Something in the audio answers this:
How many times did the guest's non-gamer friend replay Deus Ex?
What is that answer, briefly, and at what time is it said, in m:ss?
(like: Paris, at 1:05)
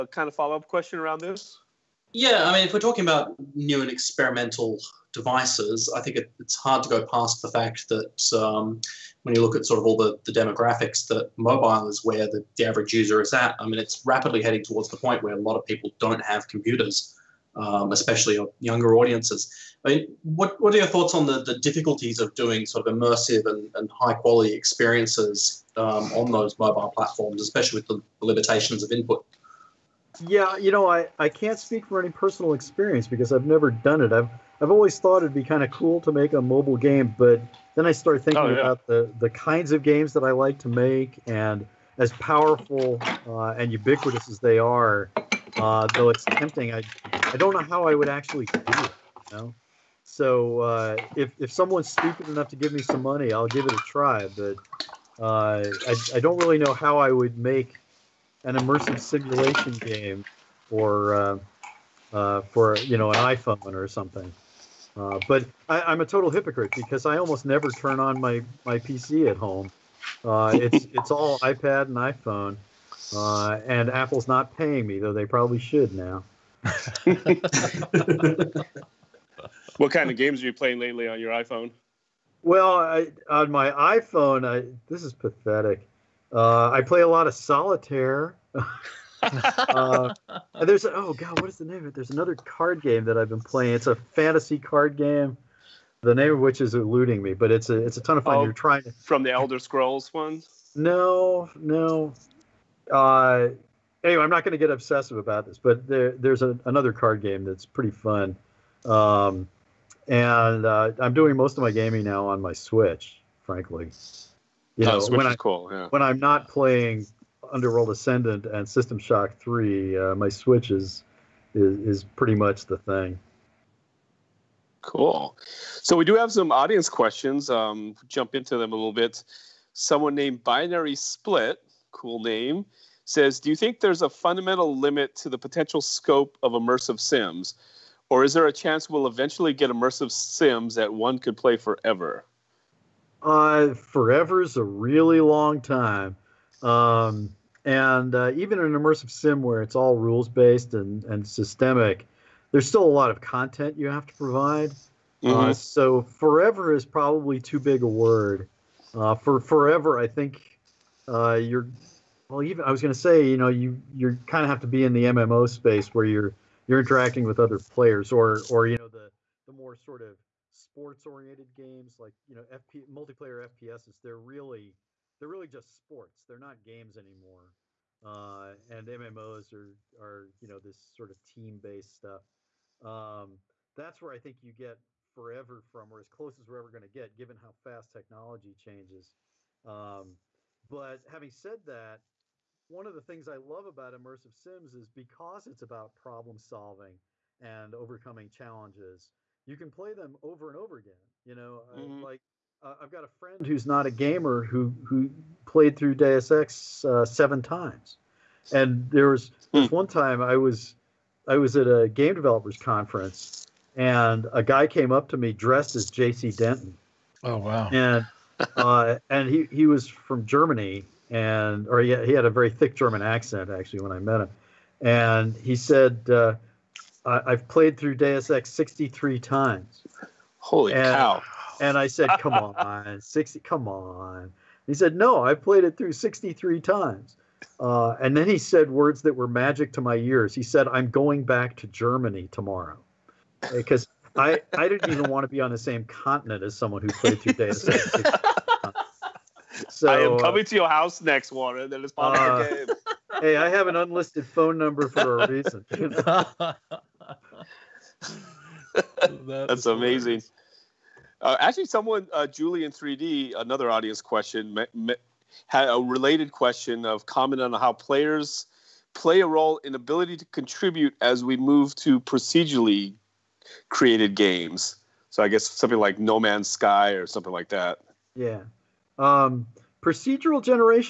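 7, at 3:27.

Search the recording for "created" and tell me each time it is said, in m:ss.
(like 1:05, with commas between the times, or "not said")
4:33.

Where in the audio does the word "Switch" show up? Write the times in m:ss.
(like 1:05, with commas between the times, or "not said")
1:52, 2:00.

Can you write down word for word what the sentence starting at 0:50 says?
So uh, if if someone's stupid enough to give me some money, I'll give it a try.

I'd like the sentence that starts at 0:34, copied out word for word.
I've I've always thought it'd be kind of cool to make a mobile game, but then I started thinking oh, yeah.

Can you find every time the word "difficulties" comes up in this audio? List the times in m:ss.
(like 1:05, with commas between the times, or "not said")
0:21.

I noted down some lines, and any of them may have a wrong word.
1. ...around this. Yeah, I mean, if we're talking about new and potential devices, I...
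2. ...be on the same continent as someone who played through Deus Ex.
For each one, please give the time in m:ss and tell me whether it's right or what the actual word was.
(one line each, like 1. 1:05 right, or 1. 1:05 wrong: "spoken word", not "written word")
1. 0:00 wrong: "experimental", not "potential"
2. 4:05 right.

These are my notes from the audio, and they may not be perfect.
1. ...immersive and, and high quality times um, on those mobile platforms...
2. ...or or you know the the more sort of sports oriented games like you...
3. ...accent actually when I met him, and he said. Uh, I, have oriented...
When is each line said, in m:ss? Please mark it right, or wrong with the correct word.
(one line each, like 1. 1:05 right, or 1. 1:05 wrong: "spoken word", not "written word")
1. 0:22 wrong: "experiences", not "times"
2. 2:48 right
3. 3:43 wrong: "played", not "oriented".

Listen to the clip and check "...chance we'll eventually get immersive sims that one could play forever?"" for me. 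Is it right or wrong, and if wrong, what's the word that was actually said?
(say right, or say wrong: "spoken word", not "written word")
right.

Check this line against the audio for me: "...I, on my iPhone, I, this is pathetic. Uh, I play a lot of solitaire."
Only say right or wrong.
right.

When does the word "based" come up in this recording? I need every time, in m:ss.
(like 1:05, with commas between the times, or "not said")
2:30, 3:01.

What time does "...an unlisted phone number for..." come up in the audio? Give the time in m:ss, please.
4:13.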